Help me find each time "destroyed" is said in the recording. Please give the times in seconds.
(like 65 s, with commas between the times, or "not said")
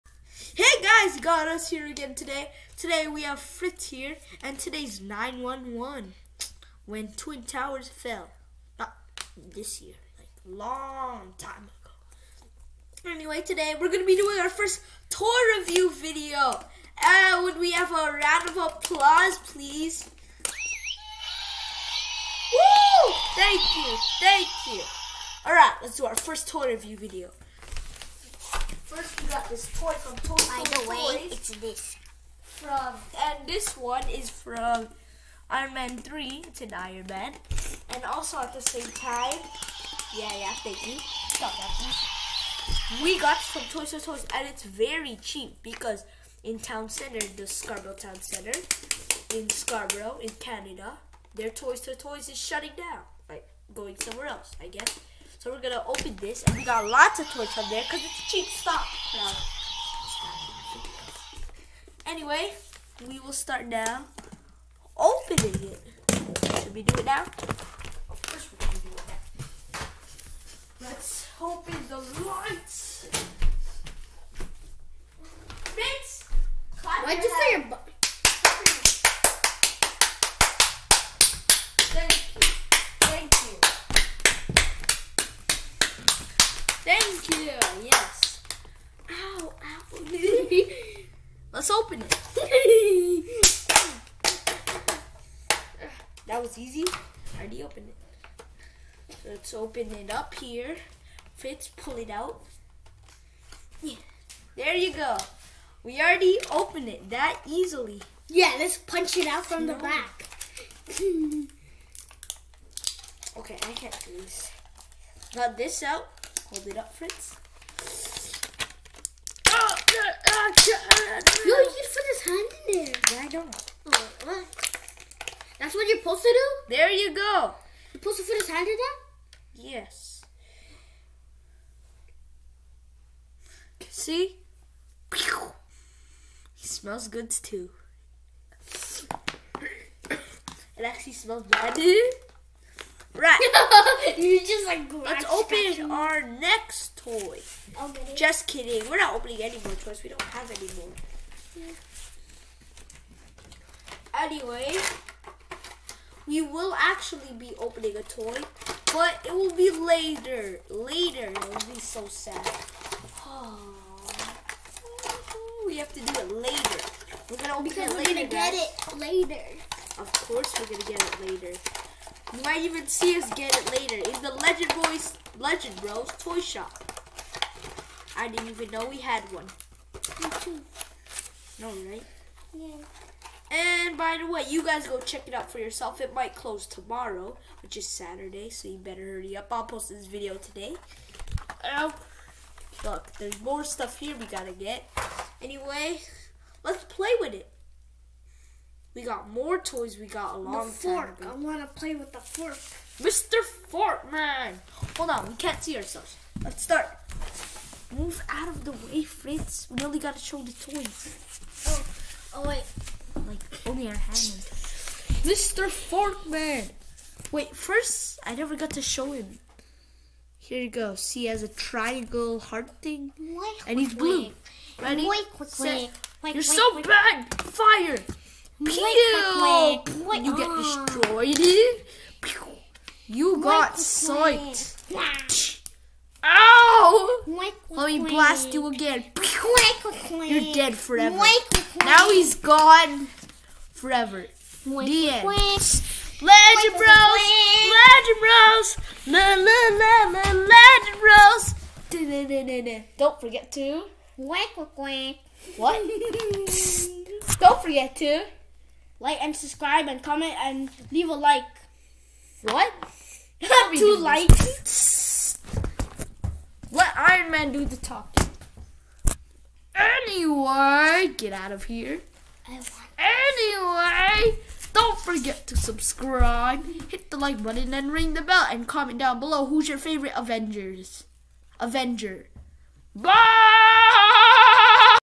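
230 s.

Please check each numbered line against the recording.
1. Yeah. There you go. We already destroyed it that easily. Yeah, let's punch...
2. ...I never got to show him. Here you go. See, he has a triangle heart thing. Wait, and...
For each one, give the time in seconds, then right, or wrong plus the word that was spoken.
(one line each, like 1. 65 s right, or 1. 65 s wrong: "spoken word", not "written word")
1. 103 s wrong: "opened", not "destroyed"
2. 218 s right.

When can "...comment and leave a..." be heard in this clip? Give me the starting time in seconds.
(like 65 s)
260 s.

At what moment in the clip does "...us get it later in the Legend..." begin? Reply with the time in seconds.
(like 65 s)
173 s.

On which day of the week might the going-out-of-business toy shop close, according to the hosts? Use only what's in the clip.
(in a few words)
Saturday.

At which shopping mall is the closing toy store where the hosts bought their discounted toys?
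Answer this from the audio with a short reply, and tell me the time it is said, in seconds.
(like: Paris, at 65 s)
Scarborough Town Center, at 47 s.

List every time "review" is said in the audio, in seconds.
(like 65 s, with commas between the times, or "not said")
15 s, 26 s.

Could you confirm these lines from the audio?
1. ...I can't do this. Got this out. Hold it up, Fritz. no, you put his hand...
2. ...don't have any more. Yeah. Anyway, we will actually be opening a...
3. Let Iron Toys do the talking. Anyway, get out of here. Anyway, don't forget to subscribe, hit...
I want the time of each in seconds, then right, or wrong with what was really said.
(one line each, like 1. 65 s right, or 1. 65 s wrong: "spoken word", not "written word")
1. 113 s right
2. 150 s right
3. 266 s wrong: "Man", not "Toys".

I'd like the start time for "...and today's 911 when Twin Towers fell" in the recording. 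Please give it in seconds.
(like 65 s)
4 s.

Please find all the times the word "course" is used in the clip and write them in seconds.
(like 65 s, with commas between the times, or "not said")
68 s, 170 s.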